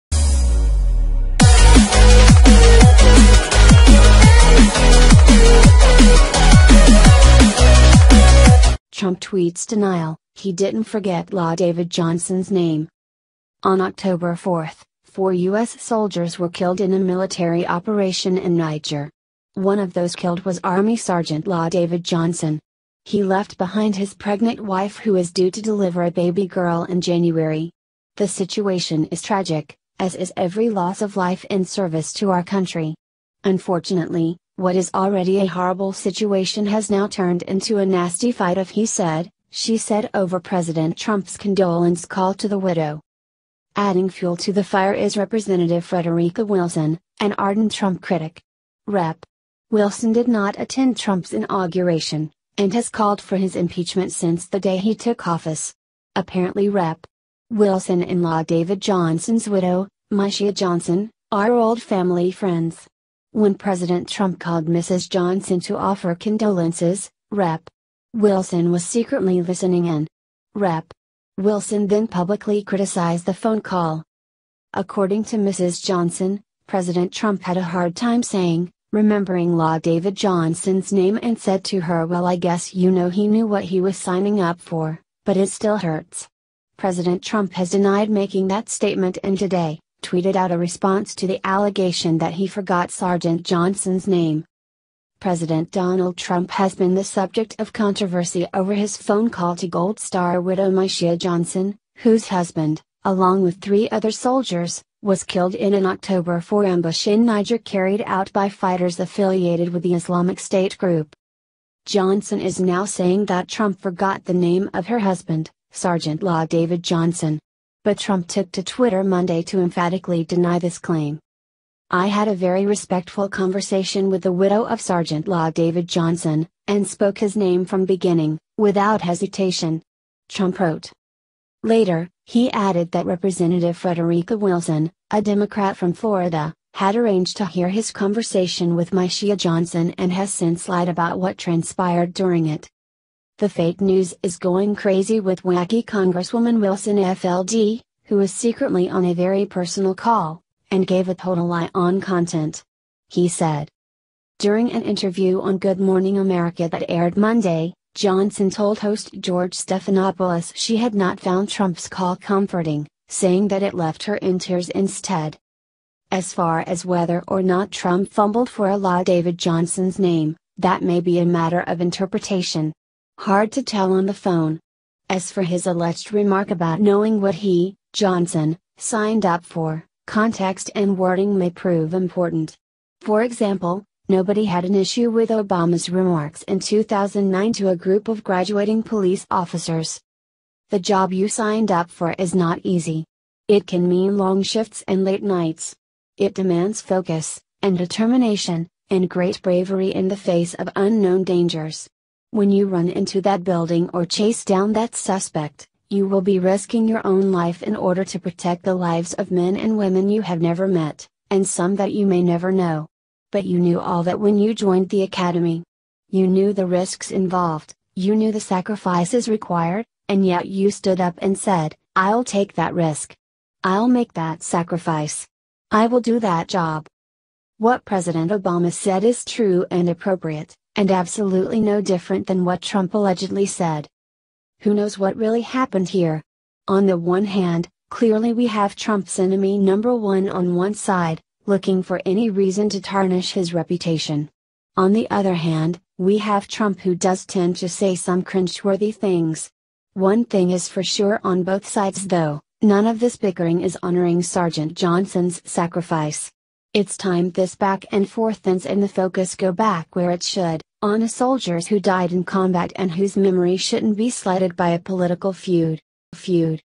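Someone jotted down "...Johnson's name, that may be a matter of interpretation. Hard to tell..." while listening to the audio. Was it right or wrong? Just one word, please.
right.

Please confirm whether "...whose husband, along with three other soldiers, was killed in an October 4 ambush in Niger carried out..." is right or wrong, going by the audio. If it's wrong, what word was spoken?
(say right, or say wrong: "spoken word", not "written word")
right.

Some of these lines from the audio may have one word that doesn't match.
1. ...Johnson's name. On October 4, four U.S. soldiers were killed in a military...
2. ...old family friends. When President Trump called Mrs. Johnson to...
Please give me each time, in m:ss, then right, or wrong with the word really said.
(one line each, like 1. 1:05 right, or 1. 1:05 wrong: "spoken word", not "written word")
1. 0:11 right
2. 1:01 right.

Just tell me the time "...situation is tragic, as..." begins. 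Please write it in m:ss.
0:28.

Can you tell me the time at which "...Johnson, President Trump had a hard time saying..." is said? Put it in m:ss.
1:15.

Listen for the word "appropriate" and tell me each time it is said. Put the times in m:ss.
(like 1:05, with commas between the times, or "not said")
3:49.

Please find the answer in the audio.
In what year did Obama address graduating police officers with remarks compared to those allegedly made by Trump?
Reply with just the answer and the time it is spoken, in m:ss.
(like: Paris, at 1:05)
2009, at 3:06.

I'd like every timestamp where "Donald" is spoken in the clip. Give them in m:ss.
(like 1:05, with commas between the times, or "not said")
1:35.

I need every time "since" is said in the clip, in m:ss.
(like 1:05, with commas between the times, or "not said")
0:54, 2:20.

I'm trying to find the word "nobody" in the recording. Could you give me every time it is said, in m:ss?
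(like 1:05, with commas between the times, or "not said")
3:04.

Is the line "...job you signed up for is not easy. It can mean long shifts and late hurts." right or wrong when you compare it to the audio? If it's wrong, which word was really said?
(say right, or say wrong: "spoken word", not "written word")
wrong: "nights", not "hurts".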